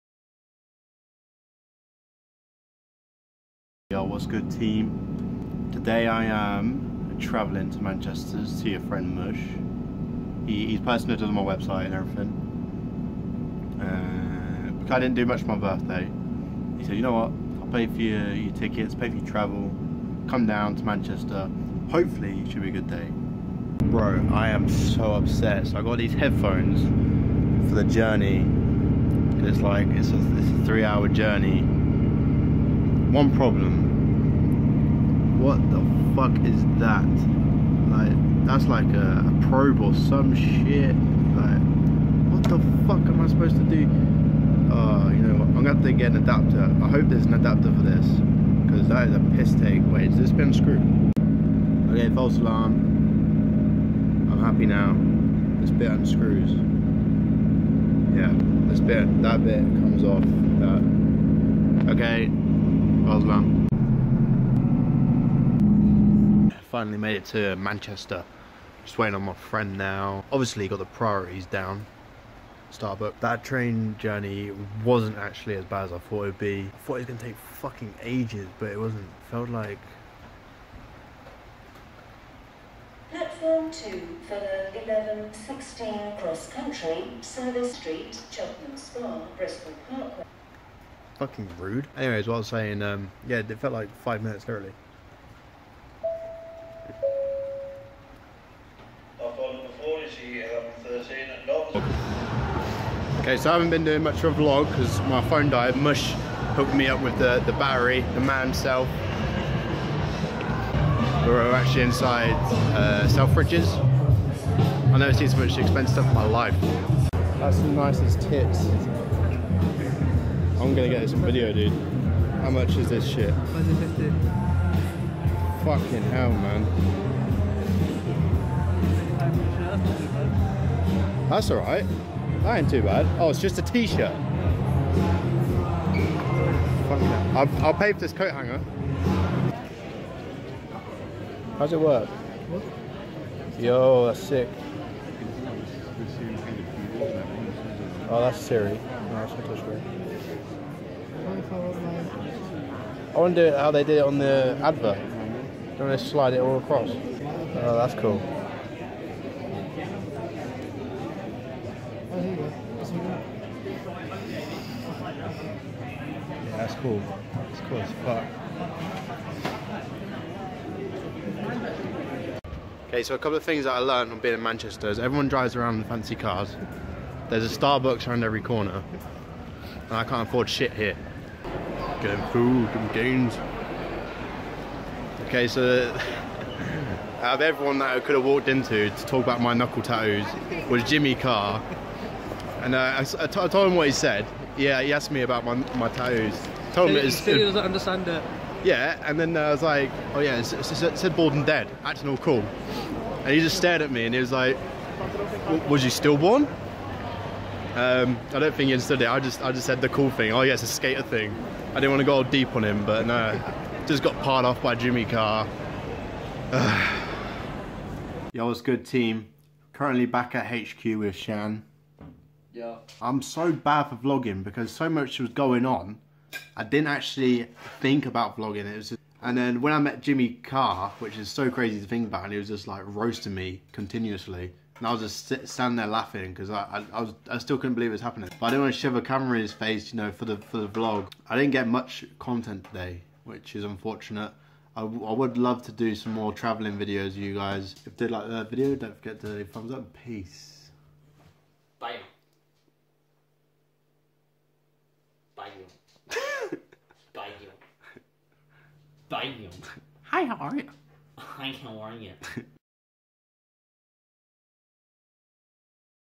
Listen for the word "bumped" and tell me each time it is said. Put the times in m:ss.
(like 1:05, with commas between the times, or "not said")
not said.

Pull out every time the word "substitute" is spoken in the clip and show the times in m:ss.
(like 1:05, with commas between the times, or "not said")
not said.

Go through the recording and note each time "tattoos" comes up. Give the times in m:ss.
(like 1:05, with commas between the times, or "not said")
3:09, 3:15.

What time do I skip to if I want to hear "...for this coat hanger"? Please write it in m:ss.
2:17.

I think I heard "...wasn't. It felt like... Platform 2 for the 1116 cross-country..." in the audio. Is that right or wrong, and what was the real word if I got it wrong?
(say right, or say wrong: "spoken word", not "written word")
right.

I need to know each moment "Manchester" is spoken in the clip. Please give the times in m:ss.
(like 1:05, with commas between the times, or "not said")
0:07, 0:20, 1:07, 2:54.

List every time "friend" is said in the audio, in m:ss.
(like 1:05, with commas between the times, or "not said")
0:08, 1:09.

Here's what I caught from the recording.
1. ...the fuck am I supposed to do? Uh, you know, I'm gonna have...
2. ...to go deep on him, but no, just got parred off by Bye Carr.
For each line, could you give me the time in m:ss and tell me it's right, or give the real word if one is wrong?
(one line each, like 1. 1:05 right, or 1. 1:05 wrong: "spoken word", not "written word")
1. 0:42 right
2. 3:32 wrong: "Jimmy", not "Bye".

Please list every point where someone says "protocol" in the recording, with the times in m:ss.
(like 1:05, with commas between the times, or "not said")
not said.